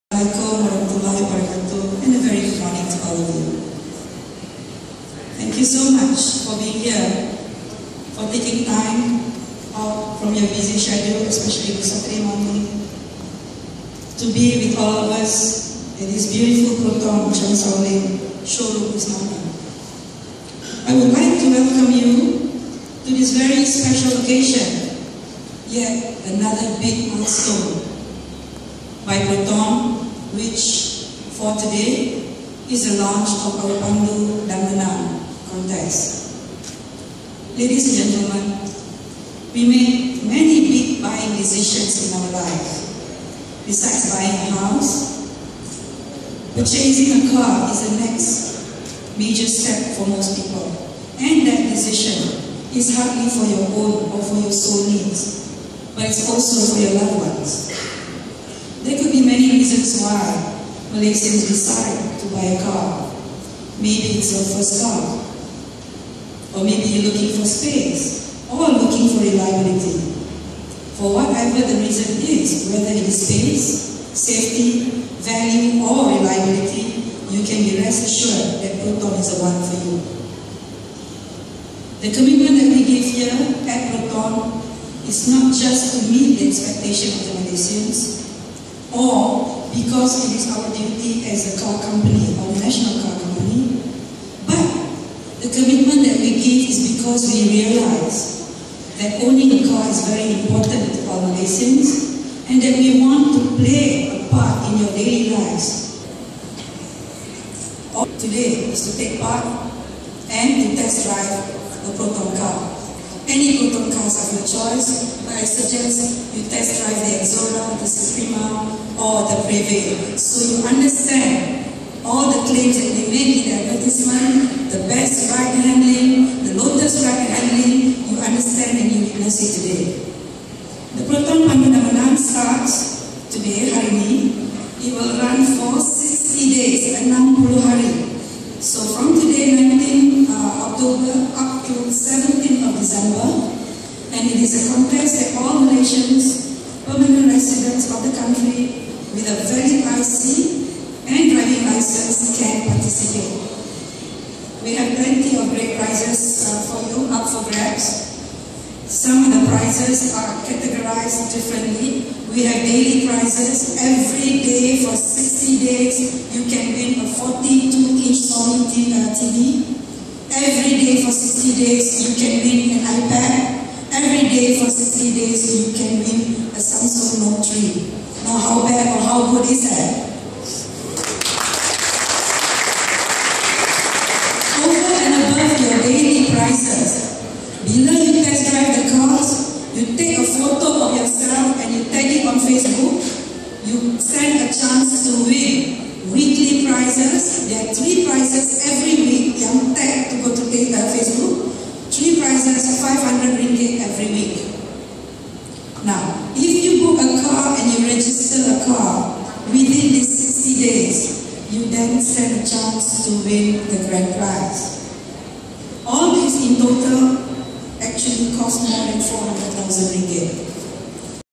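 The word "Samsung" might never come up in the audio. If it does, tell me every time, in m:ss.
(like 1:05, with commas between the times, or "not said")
2:56.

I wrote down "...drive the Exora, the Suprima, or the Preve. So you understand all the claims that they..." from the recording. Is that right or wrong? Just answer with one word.
right.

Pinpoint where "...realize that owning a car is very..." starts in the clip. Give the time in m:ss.
1:37.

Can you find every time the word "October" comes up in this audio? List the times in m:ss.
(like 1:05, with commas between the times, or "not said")
2:20.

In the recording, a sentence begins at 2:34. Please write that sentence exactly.
We have plenty of great prizes uh, for you up for grabs.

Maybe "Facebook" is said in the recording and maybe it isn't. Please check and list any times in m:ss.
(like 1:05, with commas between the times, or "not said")
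3:12, 3:20.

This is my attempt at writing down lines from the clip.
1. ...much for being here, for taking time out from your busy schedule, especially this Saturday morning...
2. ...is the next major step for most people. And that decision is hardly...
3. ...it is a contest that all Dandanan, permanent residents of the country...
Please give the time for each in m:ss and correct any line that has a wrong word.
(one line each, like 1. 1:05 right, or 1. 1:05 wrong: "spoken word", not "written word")
1. 0:05 right
2. 0:47 right
3. 2:24 wrong: "Malaysians", not "Dandanan".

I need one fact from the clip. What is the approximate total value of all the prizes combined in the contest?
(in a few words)
more than 400,000 ringgit.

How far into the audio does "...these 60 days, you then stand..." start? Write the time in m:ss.
3:29.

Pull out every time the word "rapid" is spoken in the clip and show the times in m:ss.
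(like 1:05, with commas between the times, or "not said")
not said.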